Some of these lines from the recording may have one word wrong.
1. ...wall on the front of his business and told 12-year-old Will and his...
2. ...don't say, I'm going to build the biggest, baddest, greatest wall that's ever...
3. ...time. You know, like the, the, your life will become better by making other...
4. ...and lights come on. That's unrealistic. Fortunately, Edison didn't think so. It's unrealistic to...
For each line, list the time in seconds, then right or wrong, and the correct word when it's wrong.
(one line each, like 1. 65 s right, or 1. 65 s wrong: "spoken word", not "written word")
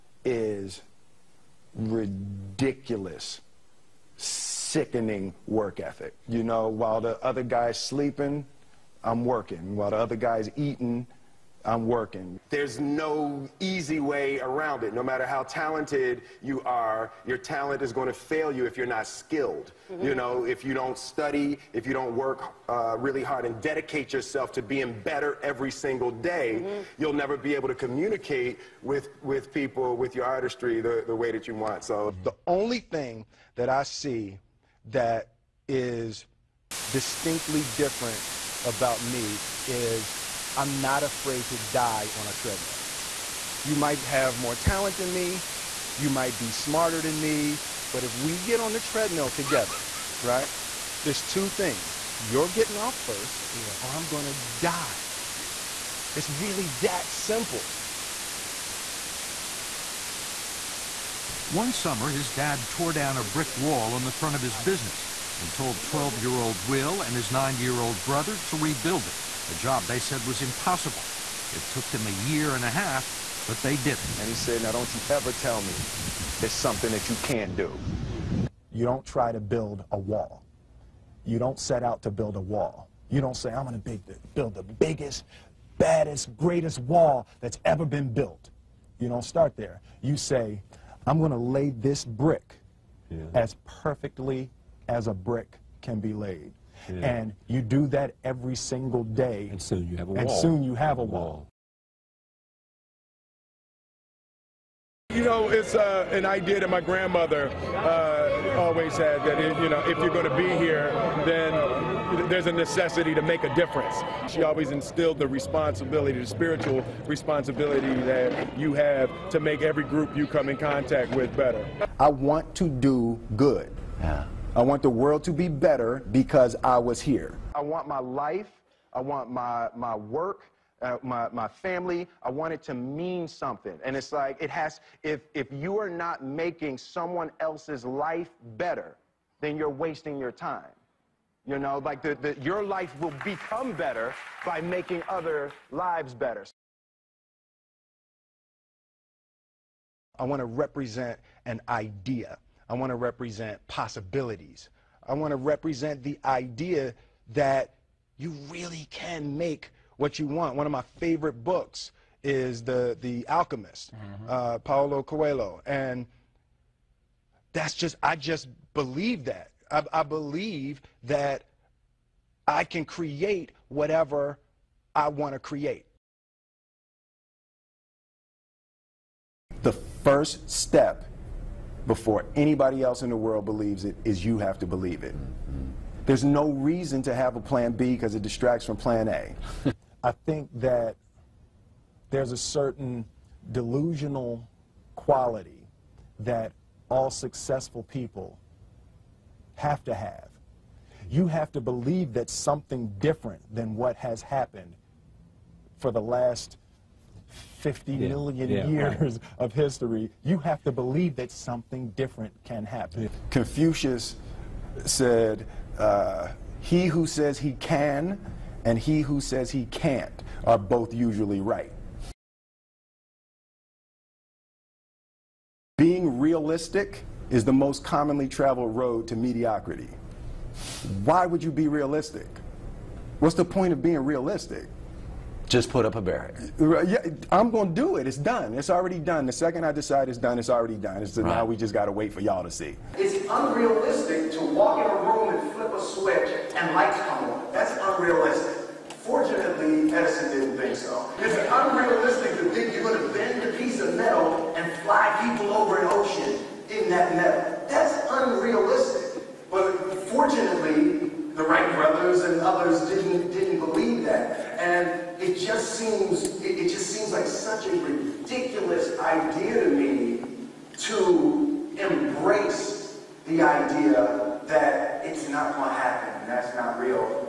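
1. 63 s right
2. 83 s right
3. 140 s right
4. 246 s right.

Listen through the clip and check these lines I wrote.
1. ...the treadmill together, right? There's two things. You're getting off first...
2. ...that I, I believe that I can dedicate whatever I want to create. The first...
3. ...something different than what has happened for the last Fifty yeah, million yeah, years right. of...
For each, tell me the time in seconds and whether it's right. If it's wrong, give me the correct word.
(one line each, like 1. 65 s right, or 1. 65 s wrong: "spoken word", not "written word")
1. 48 s right
2. 169 s wrong: "create", not "dedicate"
3. 202 s right.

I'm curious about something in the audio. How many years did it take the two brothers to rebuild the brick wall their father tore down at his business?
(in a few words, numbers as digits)
1.5 years.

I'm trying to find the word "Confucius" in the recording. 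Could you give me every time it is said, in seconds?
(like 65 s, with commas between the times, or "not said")
213 s.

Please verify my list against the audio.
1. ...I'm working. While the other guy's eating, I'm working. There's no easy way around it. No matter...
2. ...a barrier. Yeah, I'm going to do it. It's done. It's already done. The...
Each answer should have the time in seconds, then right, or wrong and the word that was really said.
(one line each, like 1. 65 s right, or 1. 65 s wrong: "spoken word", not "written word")
1. 9 s right
2. 235 s right.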